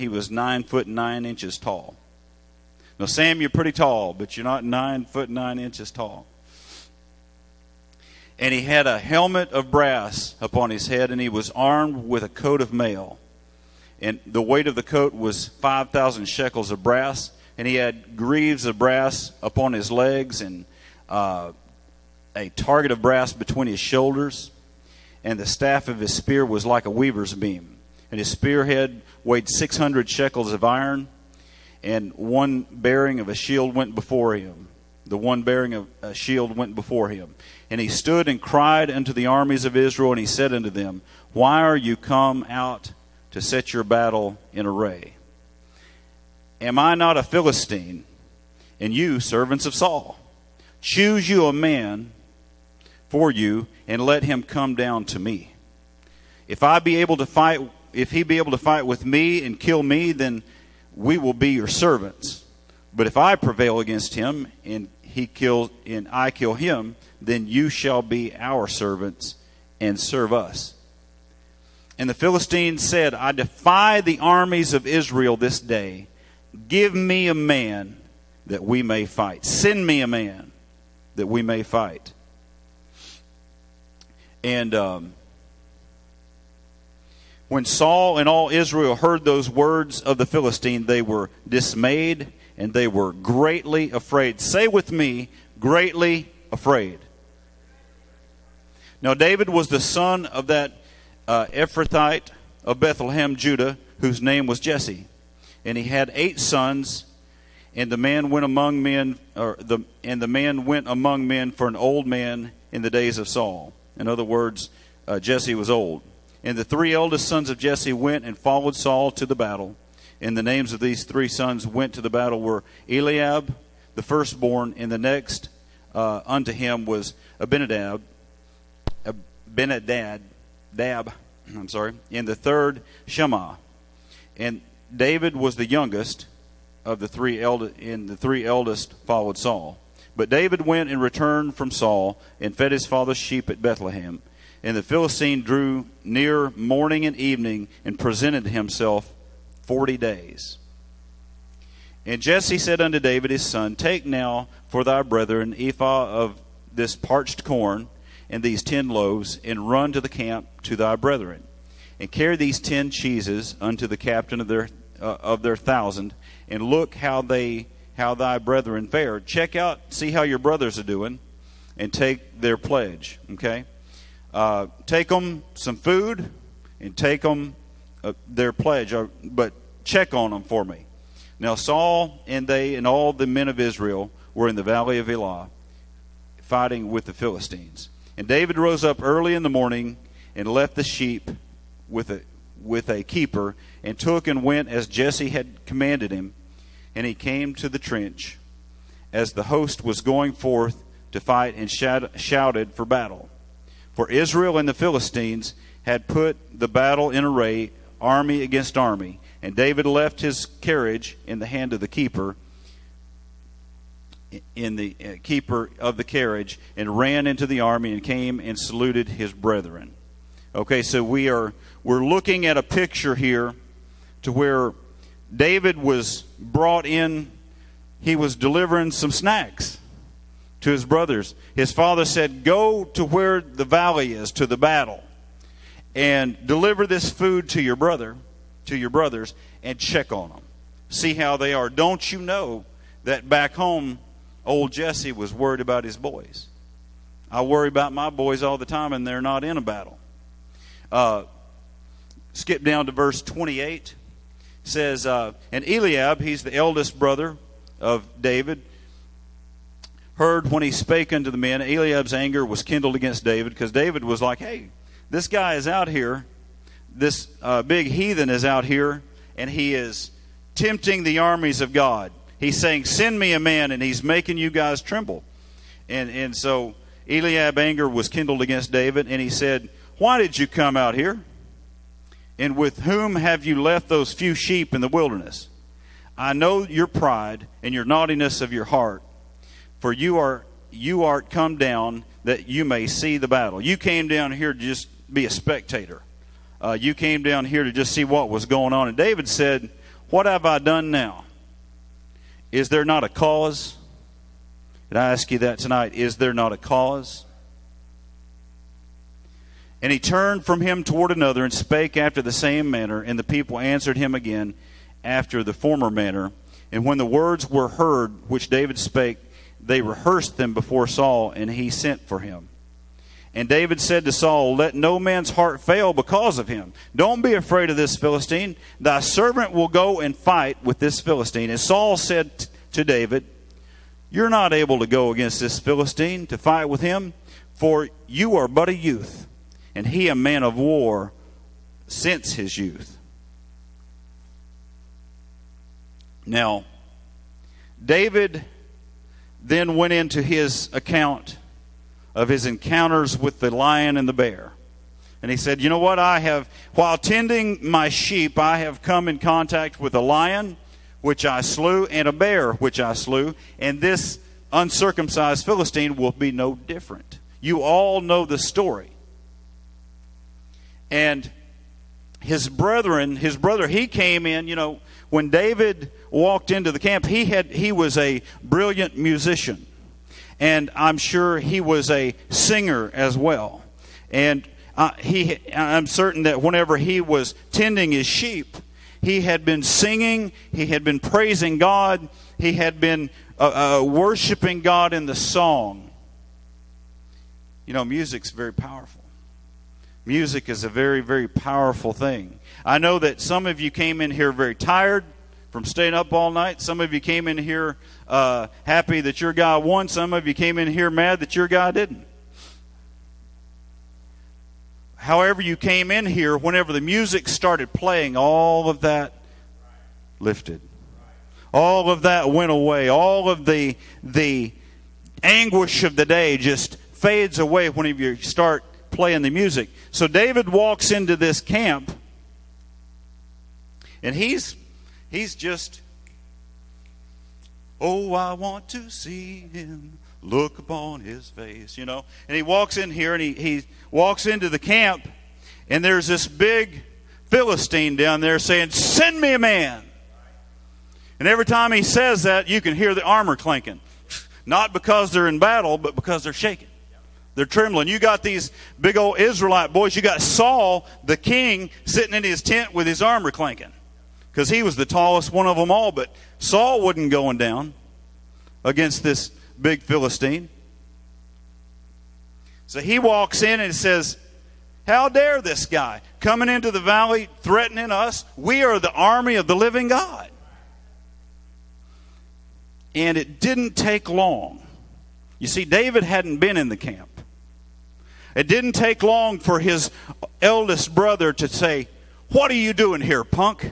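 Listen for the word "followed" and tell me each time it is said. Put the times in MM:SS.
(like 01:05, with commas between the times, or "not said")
01:58, 02:19.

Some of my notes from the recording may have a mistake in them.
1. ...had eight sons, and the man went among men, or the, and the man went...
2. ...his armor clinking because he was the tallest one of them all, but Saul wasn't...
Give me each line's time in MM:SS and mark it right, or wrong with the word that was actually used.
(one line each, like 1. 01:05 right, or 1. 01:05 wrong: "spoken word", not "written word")
1. 01:45 right
2. 07:42 right.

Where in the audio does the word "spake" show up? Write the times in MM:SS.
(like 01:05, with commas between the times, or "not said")
04:20, 05:11, 05:18.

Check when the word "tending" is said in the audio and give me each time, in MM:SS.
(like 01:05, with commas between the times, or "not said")
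05:56, 06:27.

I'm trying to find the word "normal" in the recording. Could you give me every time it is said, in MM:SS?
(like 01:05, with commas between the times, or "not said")
not said.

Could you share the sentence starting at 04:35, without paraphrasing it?
And, and so Eliab's anger was kindled against David, and he said, Why did you come out here?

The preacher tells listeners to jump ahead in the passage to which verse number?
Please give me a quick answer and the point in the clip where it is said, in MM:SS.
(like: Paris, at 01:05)
28, at 04:12.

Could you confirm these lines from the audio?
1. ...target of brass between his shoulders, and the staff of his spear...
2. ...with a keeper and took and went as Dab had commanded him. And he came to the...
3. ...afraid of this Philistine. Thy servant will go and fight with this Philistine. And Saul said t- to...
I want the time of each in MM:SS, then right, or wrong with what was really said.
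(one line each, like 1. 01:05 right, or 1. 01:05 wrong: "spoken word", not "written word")
1. 00:22 right
2. 03:12 wrong: "Jesse", not "Dab"
3. 05:27 right.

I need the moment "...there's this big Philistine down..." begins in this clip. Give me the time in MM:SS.
07:25.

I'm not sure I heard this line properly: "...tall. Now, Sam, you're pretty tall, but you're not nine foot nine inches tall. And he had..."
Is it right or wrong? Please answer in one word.
right.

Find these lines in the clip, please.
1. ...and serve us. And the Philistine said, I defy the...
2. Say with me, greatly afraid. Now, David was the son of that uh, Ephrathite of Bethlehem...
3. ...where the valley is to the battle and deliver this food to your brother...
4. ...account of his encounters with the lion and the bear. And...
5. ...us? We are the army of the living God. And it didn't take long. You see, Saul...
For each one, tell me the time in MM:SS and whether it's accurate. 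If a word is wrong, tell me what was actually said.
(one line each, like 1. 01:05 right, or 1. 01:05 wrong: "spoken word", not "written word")
1. 01:09 right
2. 01:34 right
3. 03:53 right
4. 05:50 right
5. 07:57 wrong: "David", not "Saul".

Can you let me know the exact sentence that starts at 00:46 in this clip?
Am I not a Philistine, and you servants of Saul?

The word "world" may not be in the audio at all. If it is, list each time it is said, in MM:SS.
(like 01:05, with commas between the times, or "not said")
not said.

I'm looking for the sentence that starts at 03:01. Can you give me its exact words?
Now Saul and they and all the men of Israel were in the valley of Elah, fighting with the Philistines.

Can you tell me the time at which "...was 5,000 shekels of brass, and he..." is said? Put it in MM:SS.
00:15.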